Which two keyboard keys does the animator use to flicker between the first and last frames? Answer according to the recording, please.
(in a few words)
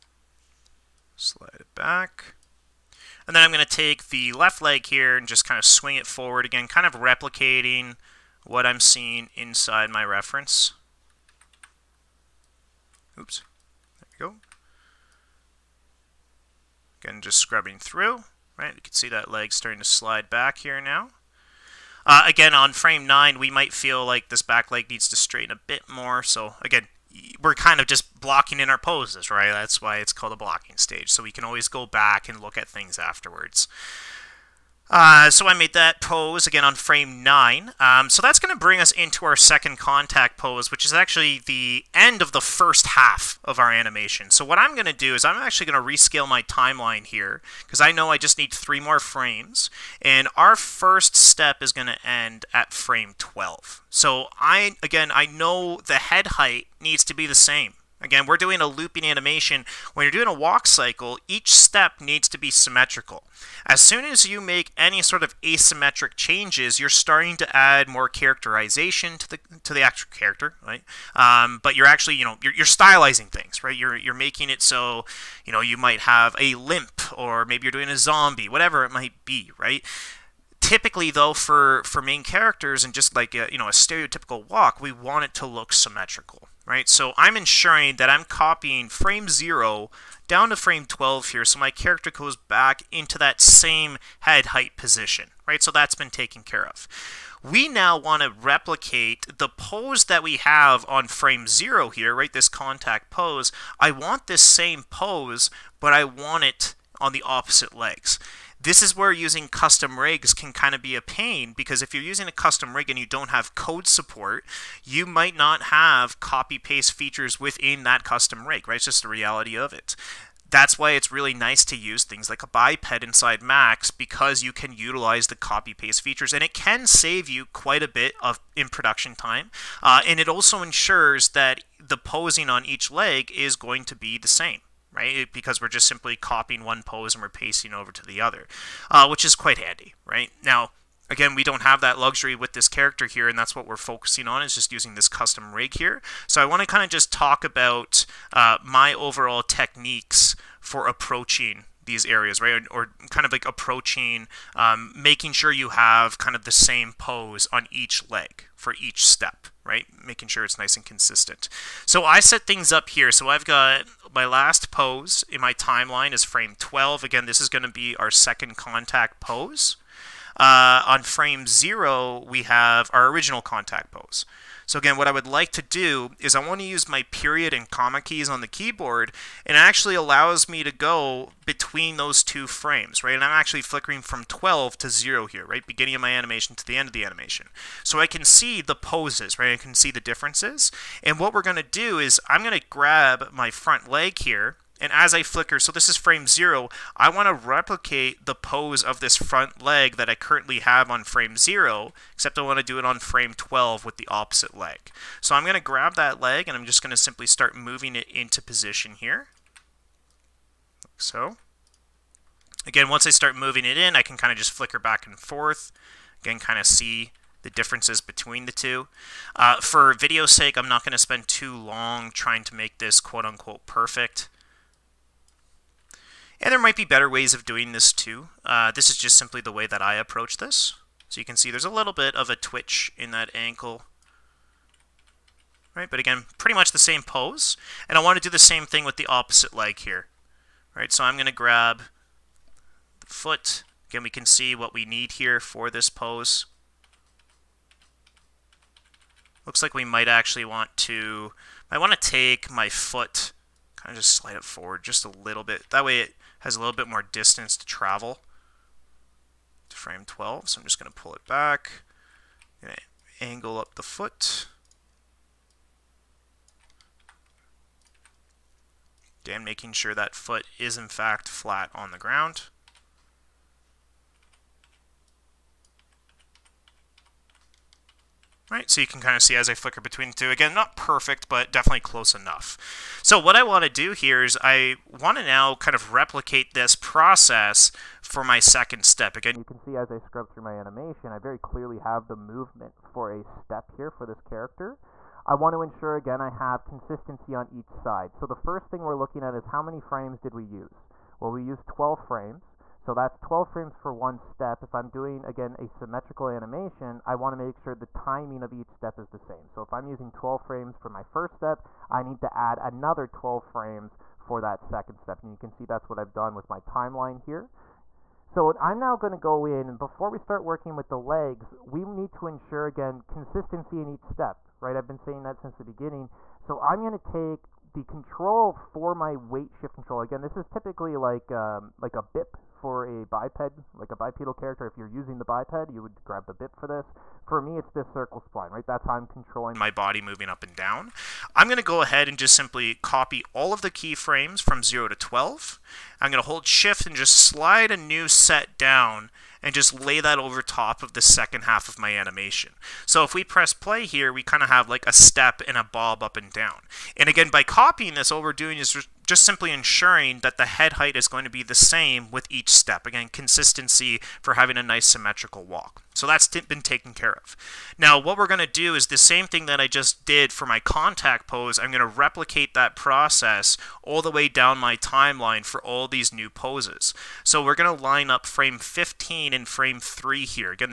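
period and comma.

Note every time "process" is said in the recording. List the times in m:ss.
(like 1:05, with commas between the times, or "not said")
4:46, 6:12.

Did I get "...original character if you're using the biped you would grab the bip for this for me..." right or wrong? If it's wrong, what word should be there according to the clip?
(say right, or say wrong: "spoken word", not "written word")
wrong: "bipedal", not "original".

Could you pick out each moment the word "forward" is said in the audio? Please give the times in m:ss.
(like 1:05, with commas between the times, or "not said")
0:06, 4:14.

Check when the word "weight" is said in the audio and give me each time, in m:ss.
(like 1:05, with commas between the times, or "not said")
5:29.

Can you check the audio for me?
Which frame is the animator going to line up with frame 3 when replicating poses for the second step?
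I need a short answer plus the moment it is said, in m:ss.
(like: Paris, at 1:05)
15, at 6:18.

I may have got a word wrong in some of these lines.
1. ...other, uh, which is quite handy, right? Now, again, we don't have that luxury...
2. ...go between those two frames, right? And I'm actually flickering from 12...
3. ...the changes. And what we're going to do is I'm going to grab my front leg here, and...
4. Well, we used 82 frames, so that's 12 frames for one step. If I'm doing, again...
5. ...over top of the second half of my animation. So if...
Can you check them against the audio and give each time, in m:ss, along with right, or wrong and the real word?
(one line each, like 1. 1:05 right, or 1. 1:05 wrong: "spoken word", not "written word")
1. 2:18 right
2. 3:00 right
3. 3:09 wrong: "differences", not "changes"
4. 5:01 wrong: "12", not "82"
5. 5:50 right.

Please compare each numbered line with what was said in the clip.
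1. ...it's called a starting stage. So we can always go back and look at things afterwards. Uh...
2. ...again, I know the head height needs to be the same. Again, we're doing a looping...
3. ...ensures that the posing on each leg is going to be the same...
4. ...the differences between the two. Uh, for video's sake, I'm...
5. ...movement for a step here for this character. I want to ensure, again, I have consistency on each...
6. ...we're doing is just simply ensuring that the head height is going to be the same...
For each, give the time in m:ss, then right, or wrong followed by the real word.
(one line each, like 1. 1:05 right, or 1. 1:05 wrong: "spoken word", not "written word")
1. 0:29 wrong: "blocking", not "starting"
2. 0:54 right
3. 2:10 right
4. 3:37 right
5. 4:52 right
6. 5:58 right.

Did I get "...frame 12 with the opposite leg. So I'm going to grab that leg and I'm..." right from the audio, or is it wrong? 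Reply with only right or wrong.
right.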